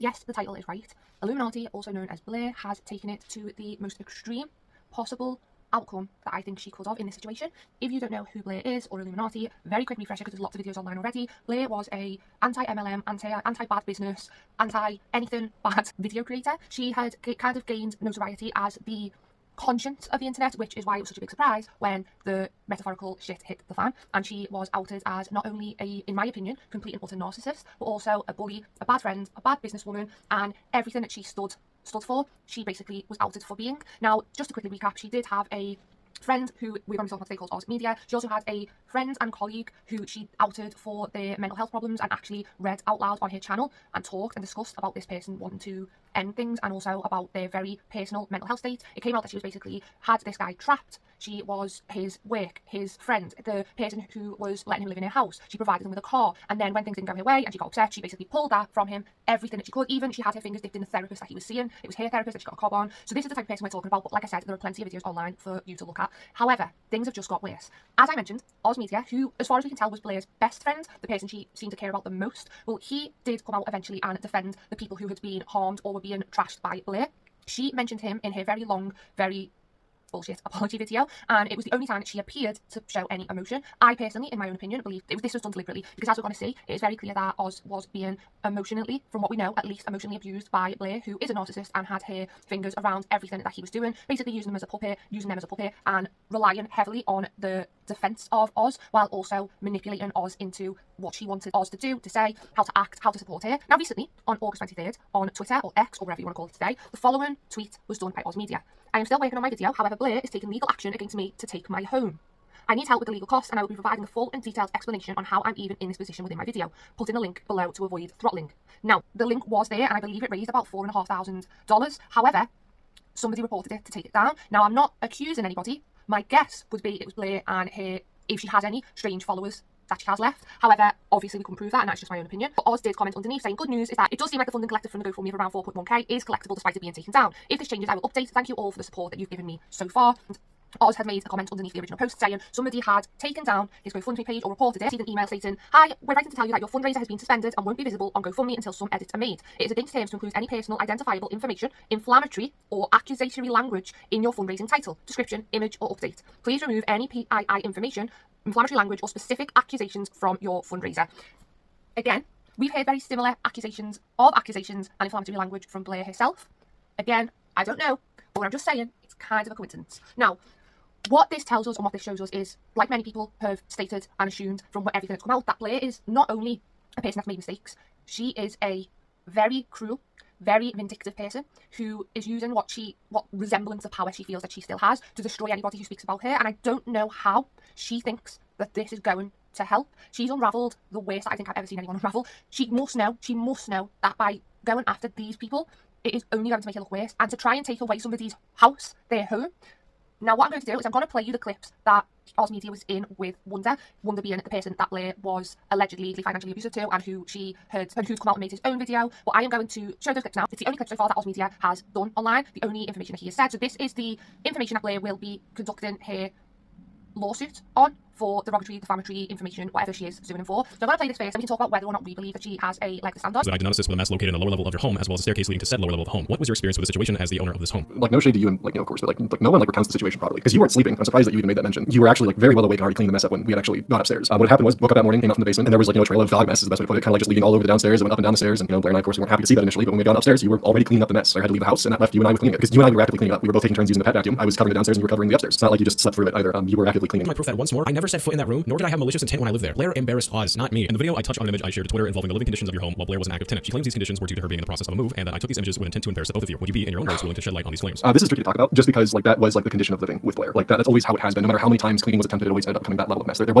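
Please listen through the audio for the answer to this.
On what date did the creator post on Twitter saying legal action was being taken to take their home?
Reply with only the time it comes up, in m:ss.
1:44.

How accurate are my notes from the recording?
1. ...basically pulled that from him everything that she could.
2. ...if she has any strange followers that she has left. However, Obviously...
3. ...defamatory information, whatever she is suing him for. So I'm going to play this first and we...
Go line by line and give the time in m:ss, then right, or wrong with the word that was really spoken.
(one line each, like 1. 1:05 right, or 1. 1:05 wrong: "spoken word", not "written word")
1. 0:57 right
2. 2:08 right
3. 3:38 right.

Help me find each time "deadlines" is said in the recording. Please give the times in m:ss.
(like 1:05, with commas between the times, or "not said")
not said.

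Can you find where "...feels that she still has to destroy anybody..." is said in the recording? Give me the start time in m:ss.
3:04.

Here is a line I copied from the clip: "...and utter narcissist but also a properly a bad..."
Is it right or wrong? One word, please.
wrong.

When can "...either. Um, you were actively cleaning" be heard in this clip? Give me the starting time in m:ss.
4:06.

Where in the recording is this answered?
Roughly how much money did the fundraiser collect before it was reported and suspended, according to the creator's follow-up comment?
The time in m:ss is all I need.
2:15.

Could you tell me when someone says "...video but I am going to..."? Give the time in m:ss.
3:28.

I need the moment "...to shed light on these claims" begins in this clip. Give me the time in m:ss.
4:17.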